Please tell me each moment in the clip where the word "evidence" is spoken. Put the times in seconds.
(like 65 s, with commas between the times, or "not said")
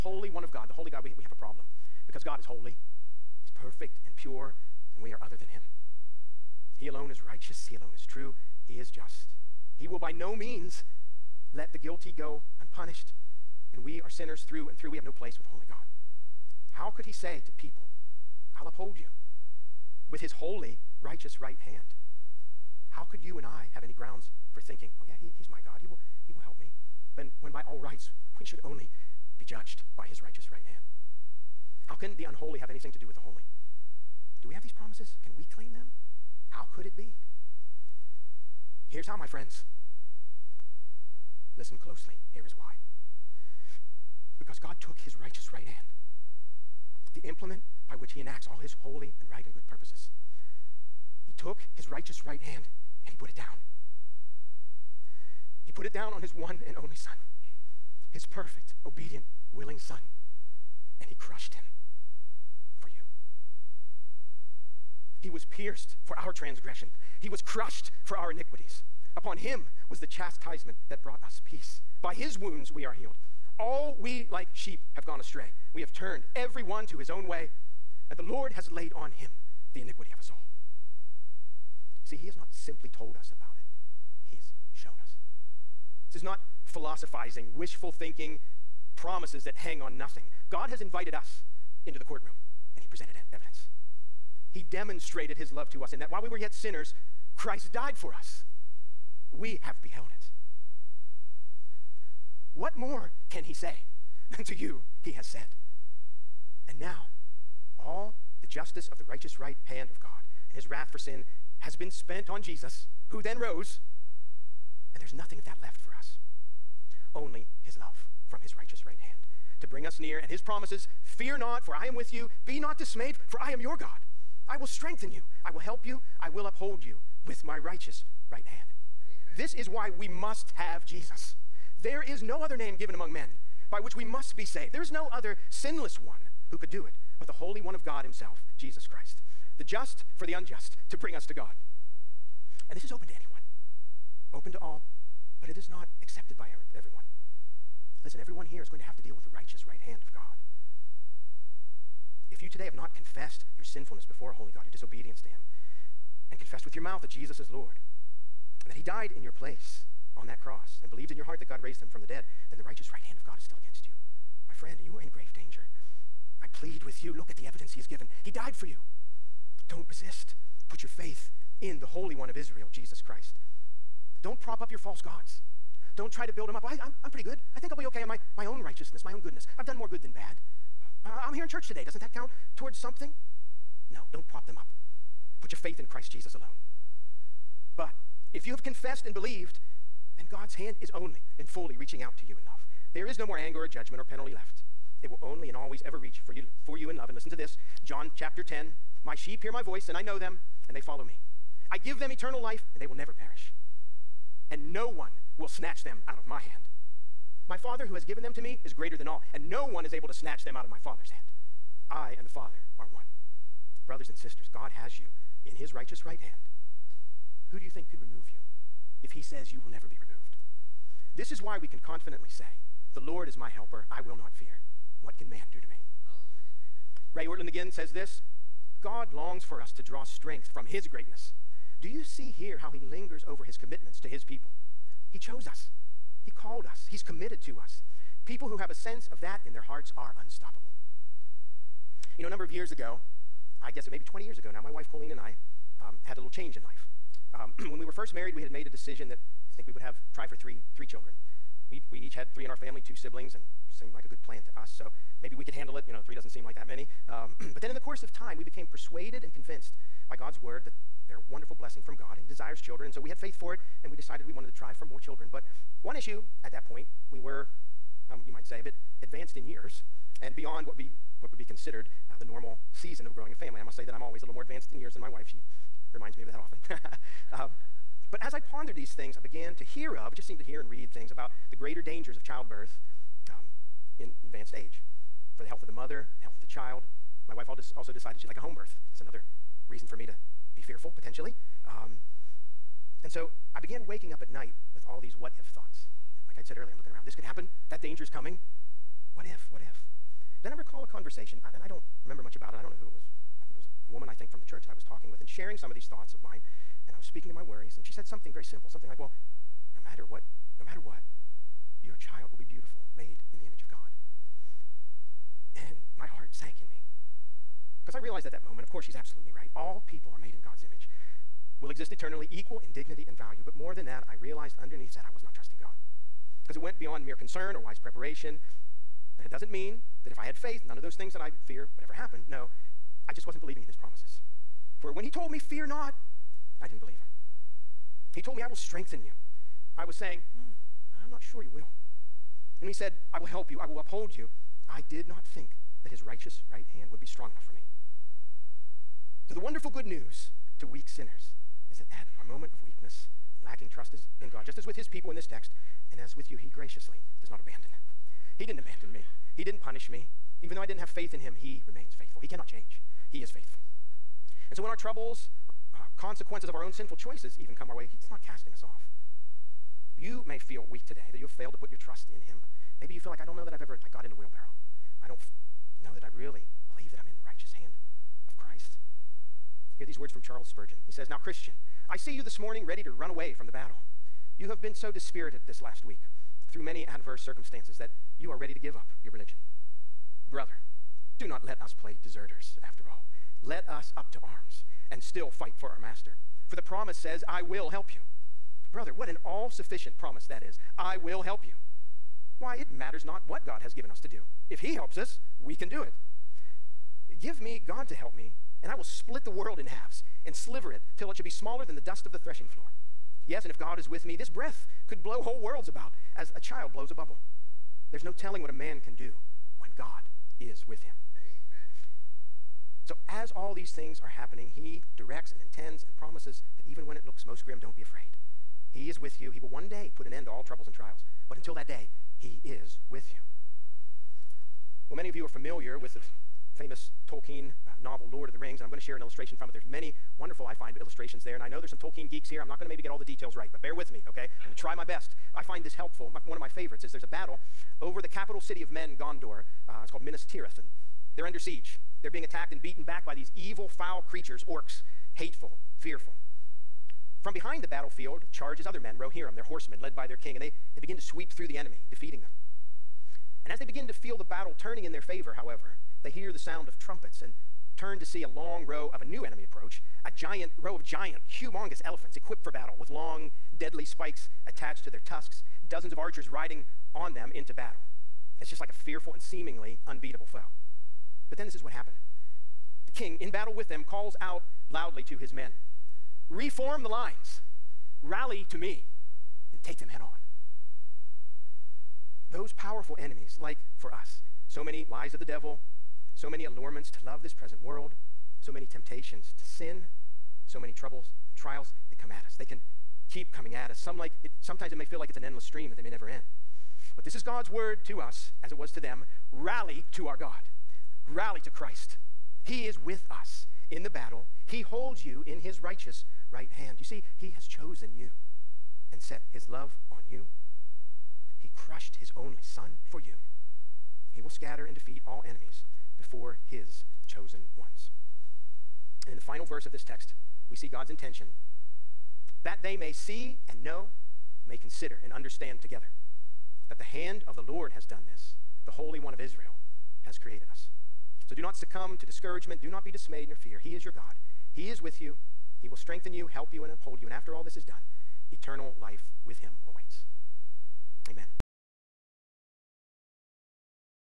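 93 s, 167 s.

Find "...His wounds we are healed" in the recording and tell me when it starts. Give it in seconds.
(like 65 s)
72 s.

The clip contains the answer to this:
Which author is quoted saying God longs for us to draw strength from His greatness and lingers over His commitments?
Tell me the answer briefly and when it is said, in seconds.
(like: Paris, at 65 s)
Ray Ortlund, at 227 s.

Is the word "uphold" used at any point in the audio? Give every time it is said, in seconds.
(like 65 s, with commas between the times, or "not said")
18 s, 126 s, 343 s, 546 s.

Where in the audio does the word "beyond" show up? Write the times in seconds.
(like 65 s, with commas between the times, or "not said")
270 s, 326 s.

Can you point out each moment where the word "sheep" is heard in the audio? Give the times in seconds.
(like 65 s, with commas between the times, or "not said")
74 s, 199 s.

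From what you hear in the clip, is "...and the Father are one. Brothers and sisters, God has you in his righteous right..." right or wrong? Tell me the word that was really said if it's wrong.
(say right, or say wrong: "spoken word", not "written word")
right.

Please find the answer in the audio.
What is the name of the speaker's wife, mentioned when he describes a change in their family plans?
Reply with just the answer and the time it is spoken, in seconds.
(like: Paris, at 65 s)
Colleen, at 244 s.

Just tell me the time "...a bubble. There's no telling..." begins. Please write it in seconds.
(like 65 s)
416 s.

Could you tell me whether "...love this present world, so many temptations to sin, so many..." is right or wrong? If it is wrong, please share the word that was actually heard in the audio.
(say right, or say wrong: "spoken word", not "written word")
right.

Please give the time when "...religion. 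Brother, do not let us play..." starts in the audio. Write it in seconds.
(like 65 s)
389 s.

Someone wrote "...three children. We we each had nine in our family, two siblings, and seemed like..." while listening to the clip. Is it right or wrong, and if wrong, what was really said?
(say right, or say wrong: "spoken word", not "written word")
wrong: "three", not "nine".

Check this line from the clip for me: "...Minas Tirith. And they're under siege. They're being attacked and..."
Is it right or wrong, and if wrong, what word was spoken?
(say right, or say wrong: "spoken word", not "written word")
right.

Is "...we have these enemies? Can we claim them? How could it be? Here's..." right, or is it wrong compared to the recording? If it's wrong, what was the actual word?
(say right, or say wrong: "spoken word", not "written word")
wrong: "promises", not "enemies".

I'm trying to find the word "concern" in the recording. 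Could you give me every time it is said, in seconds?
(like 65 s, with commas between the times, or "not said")
327 s.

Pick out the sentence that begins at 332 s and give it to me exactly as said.
No, I just wasn't believing in his promises.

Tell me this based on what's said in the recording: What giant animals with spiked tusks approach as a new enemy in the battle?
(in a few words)
Elephants.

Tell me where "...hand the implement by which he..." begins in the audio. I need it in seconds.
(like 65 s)
45 s.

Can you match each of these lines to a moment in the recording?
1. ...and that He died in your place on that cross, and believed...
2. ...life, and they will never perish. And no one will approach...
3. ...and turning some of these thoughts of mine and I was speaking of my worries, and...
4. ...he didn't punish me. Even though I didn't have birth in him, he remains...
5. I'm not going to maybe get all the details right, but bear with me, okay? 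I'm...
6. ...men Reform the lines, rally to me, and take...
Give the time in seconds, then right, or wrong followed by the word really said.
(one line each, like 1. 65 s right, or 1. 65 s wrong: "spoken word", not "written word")
1. 158 s right
2. 202 s wrong: "snatch", not "approach"
3. 305 s wrong: "sharing", not "turning"
4. 359 s wrong: "faith", not "birth"
5. 442 s right
6. 485 s right.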